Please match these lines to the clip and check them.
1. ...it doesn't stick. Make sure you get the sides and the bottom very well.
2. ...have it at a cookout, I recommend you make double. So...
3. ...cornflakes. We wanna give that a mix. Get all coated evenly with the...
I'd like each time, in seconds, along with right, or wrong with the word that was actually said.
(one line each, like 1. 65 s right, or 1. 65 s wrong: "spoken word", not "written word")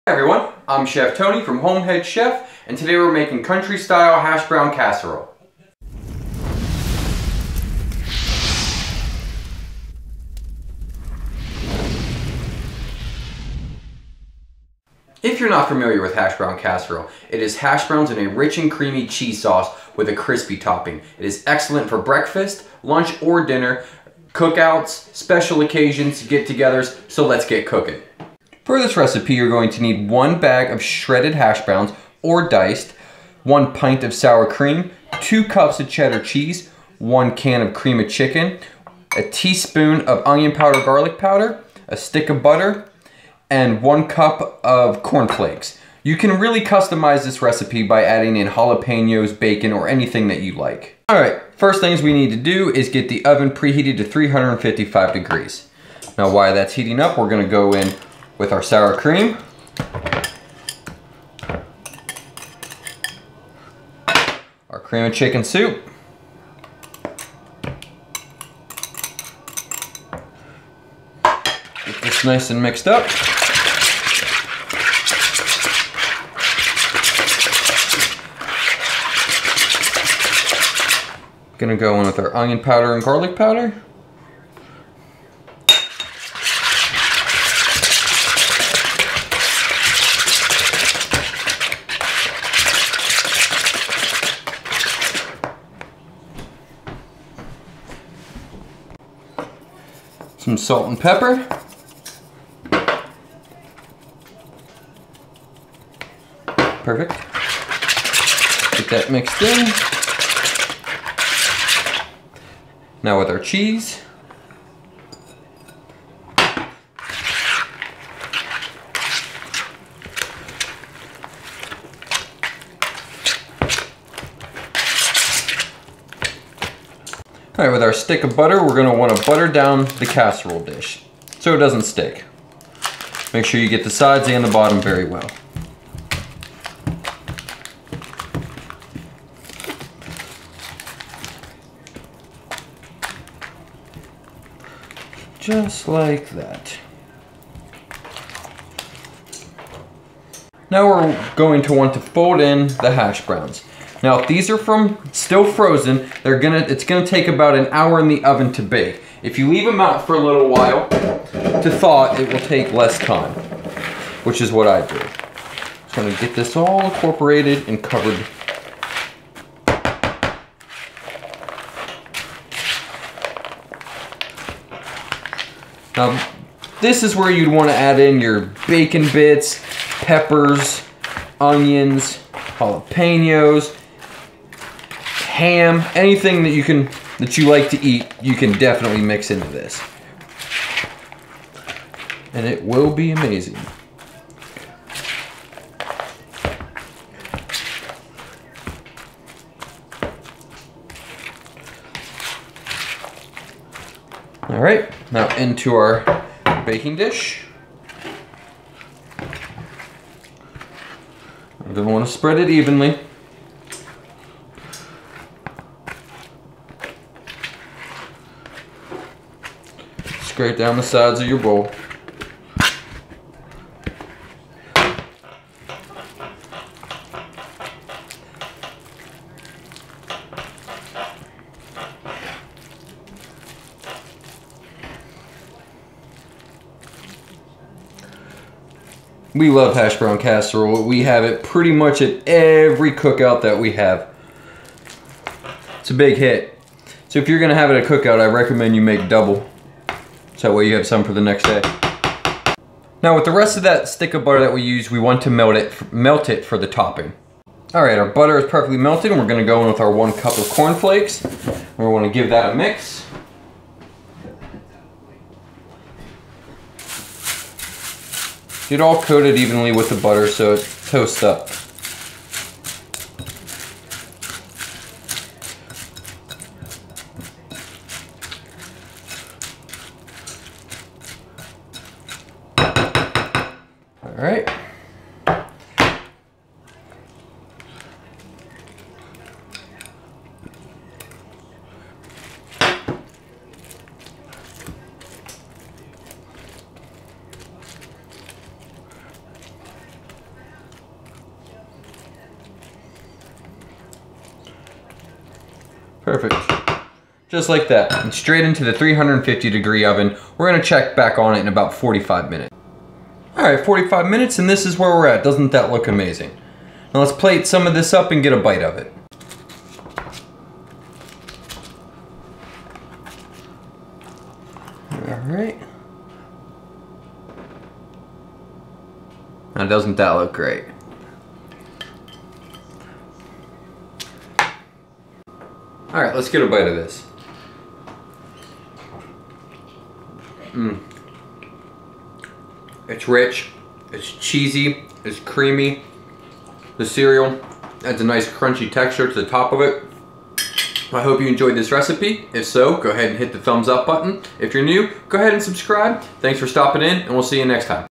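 1. 131 s right
2. 247 s right
3. 260 s right.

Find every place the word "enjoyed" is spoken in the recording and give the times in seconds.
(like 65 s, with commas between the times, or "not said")
351 s.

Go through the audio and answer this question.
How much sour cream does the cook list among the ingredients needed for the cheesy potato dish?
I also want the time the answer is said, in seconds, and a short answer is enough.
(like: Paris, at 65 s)
1 pint, at 33 s.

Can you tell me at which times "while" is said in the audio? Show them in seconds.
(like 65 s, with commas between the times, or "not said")
56 s, 160 s.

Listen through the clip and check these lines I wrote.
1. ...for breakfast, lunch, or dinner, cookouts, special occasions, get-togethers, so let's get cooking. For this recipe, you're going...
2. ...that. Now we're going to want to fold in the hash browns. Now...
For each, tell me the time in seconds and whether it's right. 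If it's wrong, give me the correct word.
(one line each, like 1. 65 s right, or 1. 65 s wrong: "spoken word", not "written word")
1. 21 s right
2. 146 s right.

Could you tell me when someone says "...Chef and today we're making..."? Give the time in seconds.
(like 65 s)
2 s.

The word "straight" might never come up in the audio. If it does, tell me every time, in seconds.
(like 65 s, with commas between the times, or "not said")
220 s, 308 s.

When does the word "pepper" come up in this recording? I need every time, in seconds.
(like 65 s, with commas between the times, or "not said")
100 s, 180 s.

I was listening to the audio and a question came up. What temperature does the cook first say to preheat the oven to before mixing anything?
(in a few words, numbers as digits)
355 degrees.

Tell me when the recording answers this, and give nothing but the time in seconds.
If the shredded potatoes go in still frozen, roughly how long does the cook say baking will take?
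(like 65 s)
157 s.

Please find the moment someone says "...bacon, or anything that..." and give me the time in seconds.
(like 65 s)
49 s.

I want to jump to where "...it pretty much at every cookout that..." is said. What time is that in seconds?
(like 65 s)
241 s.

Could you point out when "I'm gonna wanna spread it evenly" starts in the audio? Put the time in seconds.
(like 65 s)
209 s.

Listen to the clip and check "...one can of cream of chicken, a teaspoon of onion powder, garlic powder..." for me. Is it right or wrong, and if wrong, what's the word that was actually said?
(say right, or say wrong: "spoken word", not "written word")
right.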